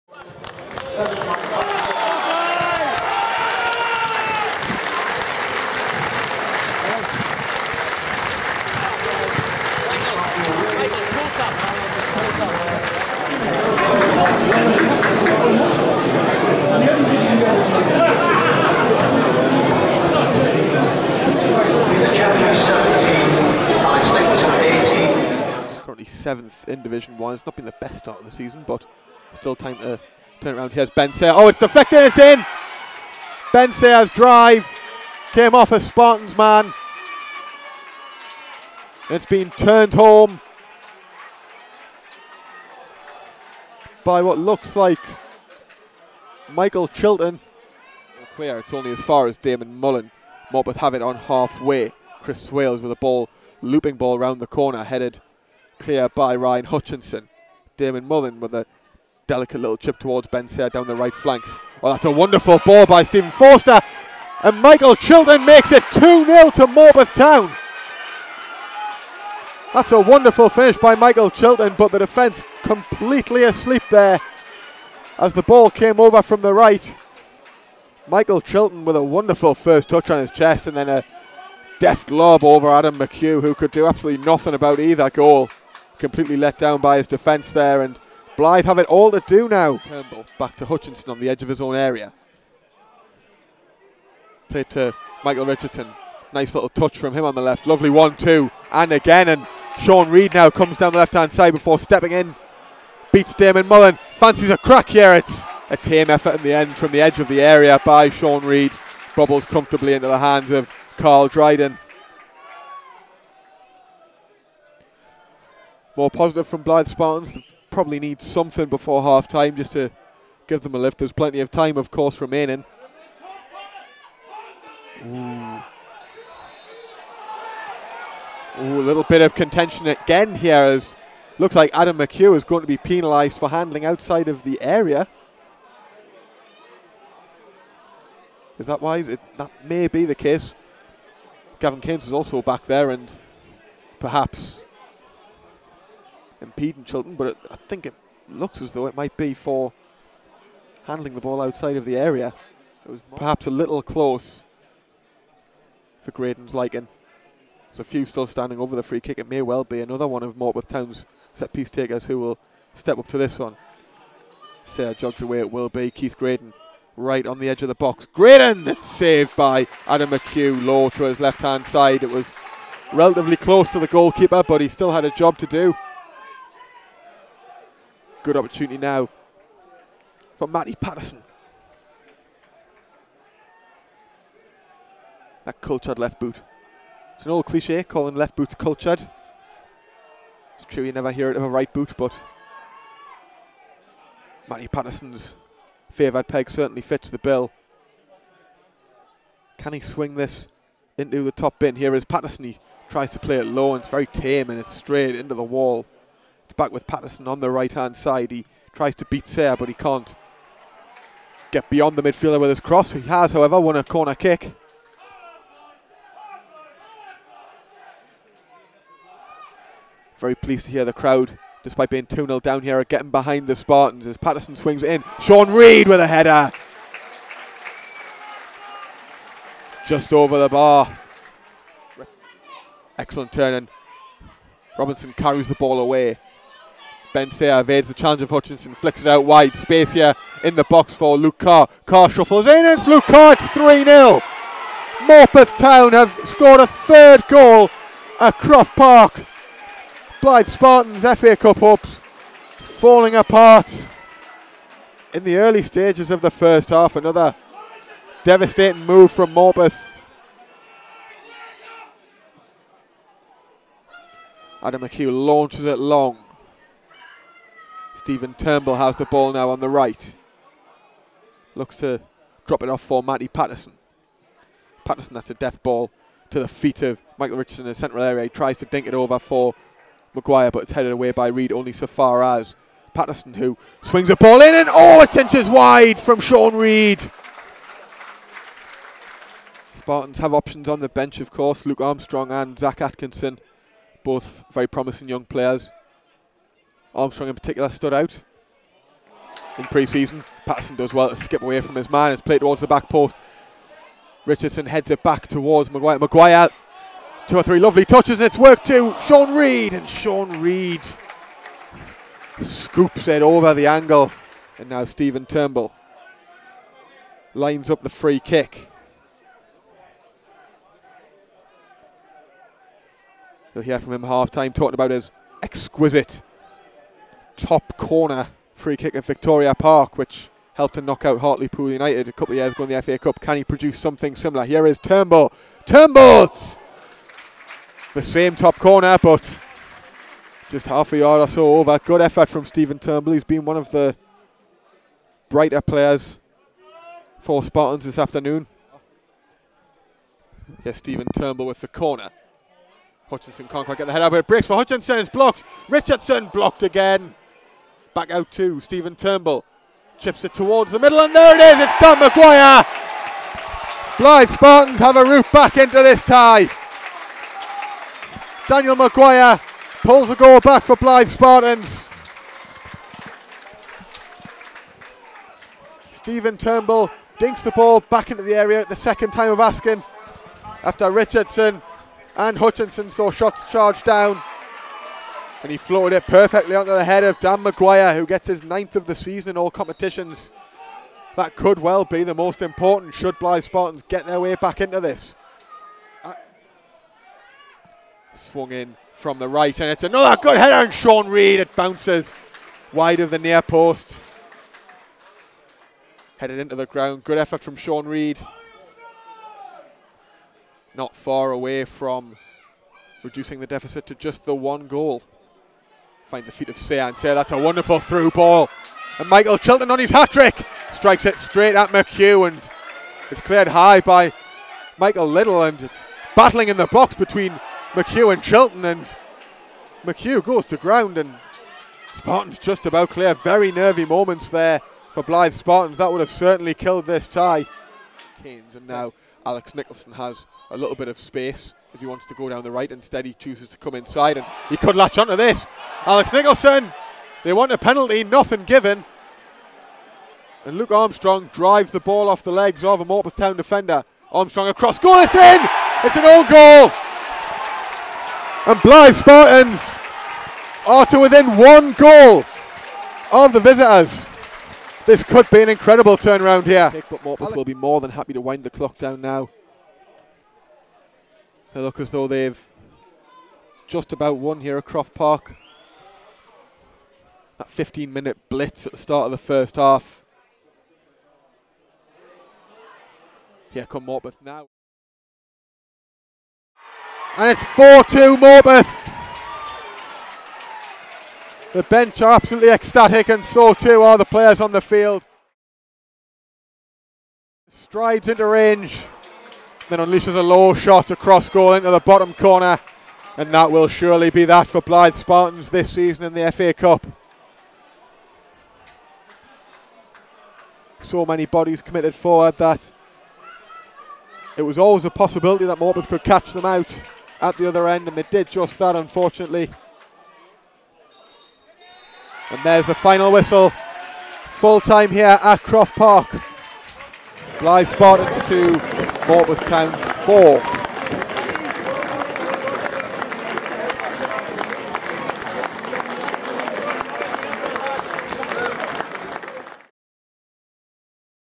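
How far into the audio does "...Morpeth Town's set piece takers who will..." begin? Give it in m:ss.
2:40.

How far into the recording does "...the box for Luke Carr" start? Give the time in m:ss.
4:00.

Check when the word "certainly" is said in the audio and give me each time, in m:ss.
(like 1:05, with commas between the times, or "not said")
3:16, 7:16.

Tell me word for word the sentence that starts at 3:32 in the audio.
He has, however, won a corner kick.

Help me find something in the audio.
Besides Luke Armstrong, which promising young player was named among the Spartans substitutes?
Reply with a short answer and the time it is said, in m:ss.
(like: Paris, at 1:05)
Zach Atkinson, at 4:52.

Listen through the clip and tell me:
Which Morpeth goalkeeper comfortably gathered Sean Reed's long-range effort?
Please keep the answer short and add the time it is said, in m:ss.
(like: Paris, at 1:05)
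Carl Dryden, at 1:50.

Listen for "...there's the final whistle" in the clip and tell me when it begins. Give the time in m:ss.
8:42.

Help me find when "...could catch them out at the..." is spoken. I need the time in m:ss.
8:35.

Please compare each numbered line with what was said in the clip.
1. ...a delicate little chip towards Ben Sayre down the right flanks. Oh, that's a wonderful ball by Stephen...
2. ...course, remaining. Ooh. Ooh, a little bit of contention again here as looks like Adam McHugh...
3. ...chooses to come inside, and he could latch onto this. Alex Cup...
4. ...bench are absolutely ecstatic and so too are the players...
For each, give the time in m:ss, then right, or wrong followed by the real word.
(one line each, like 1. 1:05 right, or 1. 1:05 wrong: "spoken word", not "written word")
1. 0:58 right
2. 2:01 right
3. 7:23 wrong: "Nicholson", not "Cup"
4. 8:11 right.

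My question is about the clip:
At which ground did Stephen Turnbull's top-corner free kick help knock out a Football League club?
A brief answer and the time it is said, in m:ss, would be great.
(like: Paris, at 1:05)
Victoria Park, at 5:29.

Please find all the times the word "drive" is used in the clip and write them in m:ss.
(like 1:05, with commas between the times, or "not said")
0:34, 7:31.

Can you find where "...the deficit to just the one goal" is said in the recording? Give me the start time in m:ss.
6:53.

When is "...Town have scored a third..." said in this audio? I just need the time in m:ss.
4:05.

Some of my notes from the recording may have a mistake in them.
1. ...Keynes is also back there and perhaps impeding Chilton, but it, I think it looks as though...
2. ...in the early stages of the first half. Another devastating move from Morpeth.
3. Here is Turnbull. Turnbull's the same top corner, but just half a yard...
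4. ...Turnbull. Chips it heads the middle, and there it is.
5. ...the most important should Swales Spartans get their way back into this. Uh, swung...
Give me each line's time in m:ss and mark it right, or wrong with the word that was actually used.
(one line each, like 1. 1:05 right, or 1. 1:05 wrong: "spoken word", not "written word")
1. 2:21 right
2. 4:15 right
3. 5:34 right
4. 5:58 wrong: "towards", not "heads"
5. 6:32 wrong: "Blyth", not "Swales".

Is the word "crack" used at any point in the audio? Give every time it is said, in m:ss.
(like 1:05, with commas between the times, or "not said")
1:44.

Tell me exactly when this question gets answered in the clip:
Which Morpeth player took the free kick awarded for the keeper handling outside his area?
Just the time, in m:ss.
2:45.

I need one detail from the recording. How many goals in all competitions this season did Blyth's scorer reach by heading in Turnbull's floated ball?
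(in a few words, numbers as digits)
9.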